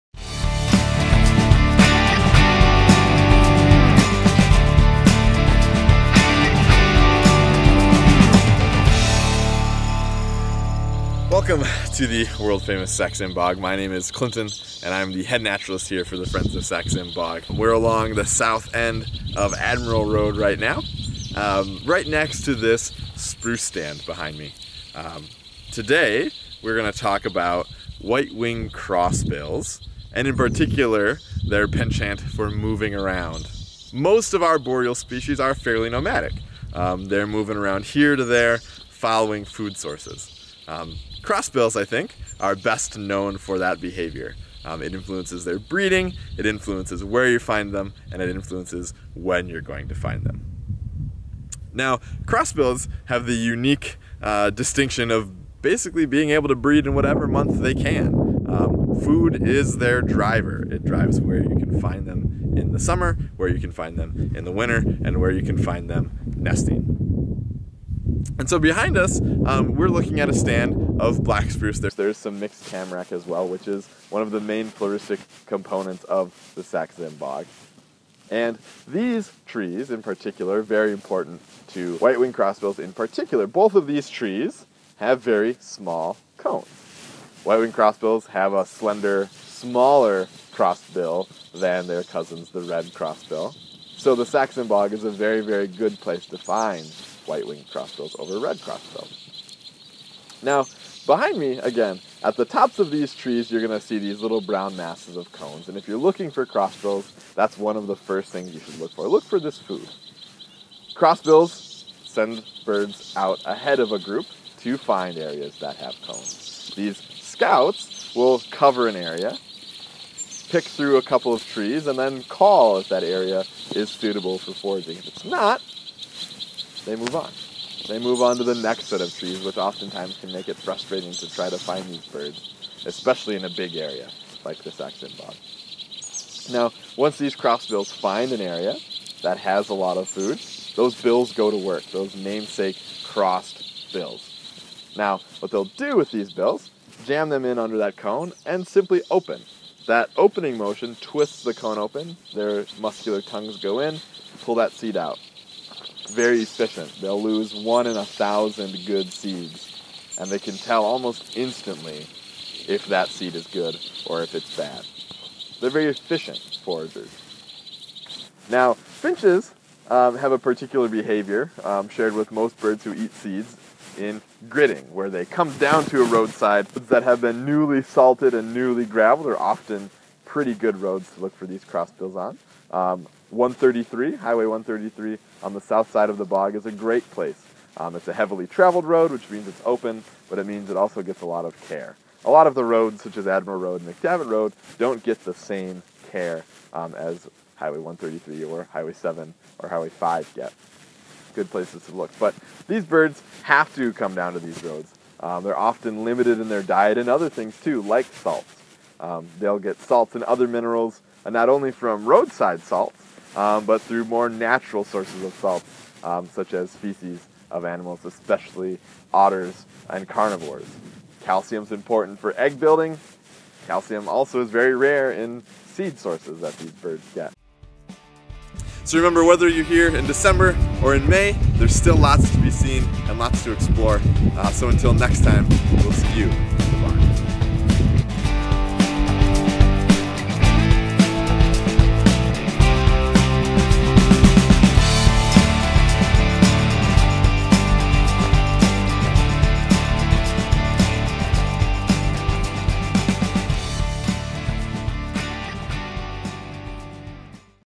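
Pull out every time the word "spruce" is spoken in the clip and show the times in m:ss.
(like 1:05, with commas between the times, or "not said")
0:23, 1:11.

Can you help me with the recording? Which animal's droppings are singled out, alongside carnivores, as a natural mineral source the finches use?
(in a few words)
Otters.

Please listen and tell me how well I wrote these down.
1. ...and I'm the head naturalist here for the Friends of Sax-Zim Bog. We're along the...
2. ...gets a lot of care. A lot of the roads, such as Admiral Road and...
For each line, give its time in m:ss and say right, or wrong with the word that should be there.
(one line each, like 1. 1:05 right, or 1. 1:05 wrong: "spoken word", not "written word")
1. 0:14 right
2. 3:11 right.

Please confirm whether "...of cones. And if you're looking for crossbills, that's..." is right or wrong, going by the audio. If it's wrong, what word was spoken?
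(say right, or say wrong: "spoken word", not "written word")
right.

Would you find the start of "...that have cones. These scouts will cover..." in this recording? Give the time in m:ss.
1:55.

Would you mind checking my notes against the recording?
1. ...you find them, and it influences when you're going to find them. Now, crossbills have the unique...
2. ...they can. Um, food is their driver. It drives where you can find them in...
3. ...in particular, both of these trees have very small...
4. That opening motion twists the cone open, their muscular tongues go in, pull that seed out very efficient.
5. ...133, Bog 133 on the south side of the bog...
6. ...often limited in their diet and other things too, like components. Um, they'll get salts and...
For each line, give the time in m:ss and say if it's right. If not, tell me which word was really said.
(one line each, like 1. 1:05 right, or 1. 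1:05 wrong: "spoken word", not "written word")
1. 0:47 right
2. 0:57 right
3. 1:22 right
4. 2:29 right
5. 3:03 wrong: "Highway", not "Bog"
6. 3:25 wrong: "salts", not "components".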